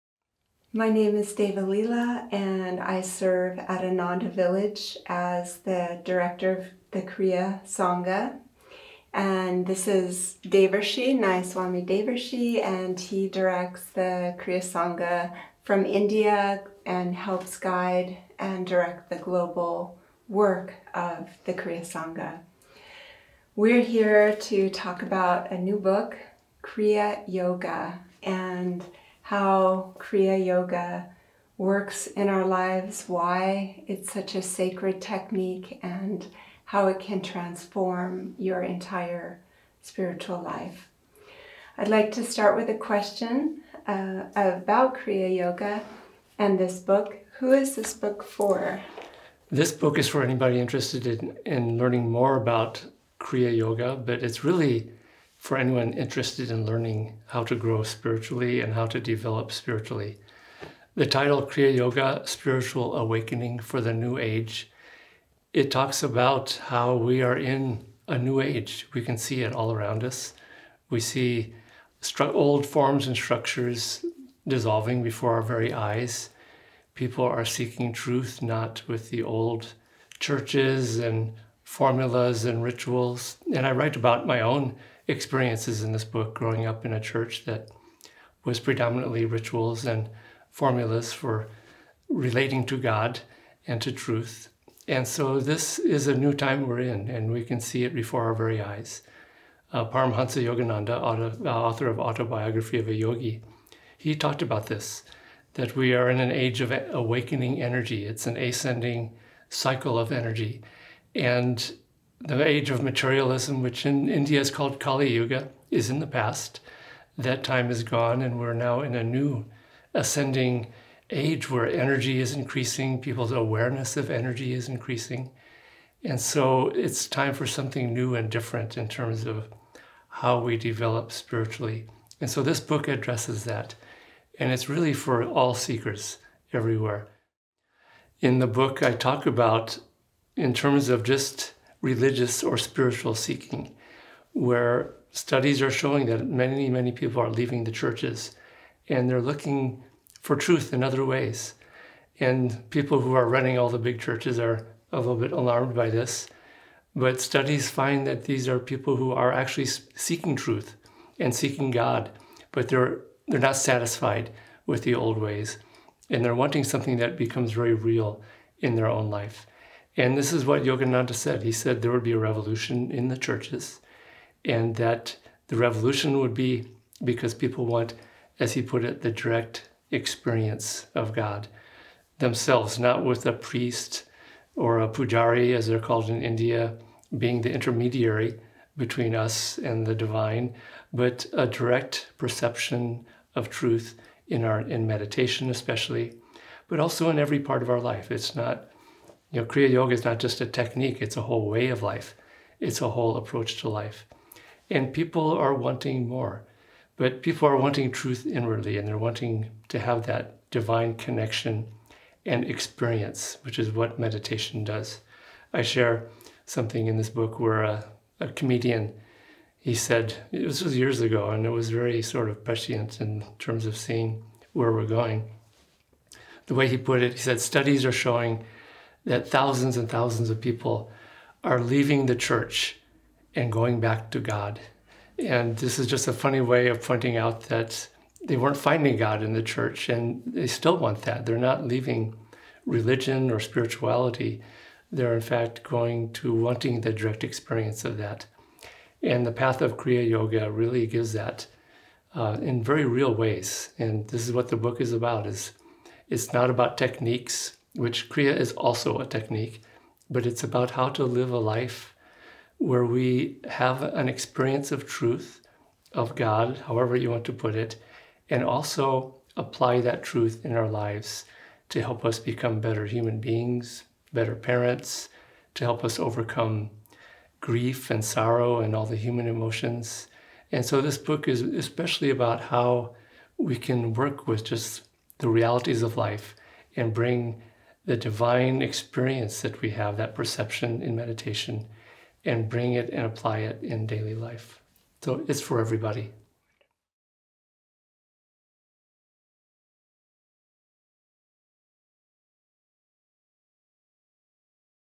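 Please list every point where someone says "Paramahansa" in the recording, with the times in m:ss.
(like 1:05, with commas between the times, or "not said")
1:39.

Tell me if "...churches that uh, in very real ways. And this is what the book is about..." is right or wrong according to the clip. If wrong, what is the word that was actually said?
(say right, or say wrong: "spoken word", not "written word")
wrong: "gives", not "churches".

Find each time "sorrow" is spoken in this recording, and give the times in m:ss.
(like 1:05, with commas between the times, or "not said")
4:38.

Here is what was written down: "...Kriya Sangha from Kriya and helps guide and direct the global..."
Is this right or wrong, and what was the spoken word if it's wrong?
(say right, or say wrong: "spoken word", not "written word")
wrong: "India", not "Kriya".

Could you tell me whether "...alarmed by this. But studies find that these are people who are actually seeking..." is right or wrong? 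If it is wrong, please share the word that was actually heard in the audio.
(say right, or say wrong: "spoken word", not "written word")
right.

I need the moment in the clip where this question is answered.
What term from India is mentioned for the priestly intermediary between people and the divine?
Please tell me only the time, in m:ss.
3:04.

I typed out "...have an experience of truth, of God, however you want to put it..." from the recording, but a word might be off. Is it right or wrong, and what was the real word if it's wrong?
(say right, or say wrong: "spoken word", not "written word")
right.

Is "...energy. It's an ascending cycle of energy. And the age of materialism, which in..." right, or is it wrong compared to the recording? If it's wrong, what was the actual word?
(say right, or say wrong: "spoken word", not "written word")
right.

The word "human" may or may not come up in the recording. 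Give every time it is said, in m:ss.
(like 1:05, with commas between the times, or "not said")
4:32, 4:38.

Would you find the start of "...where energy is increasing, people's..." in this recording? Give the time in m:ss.
2:01.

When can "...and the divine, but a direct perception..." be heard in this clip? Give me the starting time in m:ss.
3:09.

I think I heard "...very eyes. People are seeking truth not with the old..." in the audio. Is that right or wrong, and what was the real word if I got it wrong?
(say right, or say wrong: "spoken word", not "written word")
right.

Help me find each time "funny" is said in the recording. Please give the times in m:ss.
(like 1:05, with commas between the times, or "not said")
3:56.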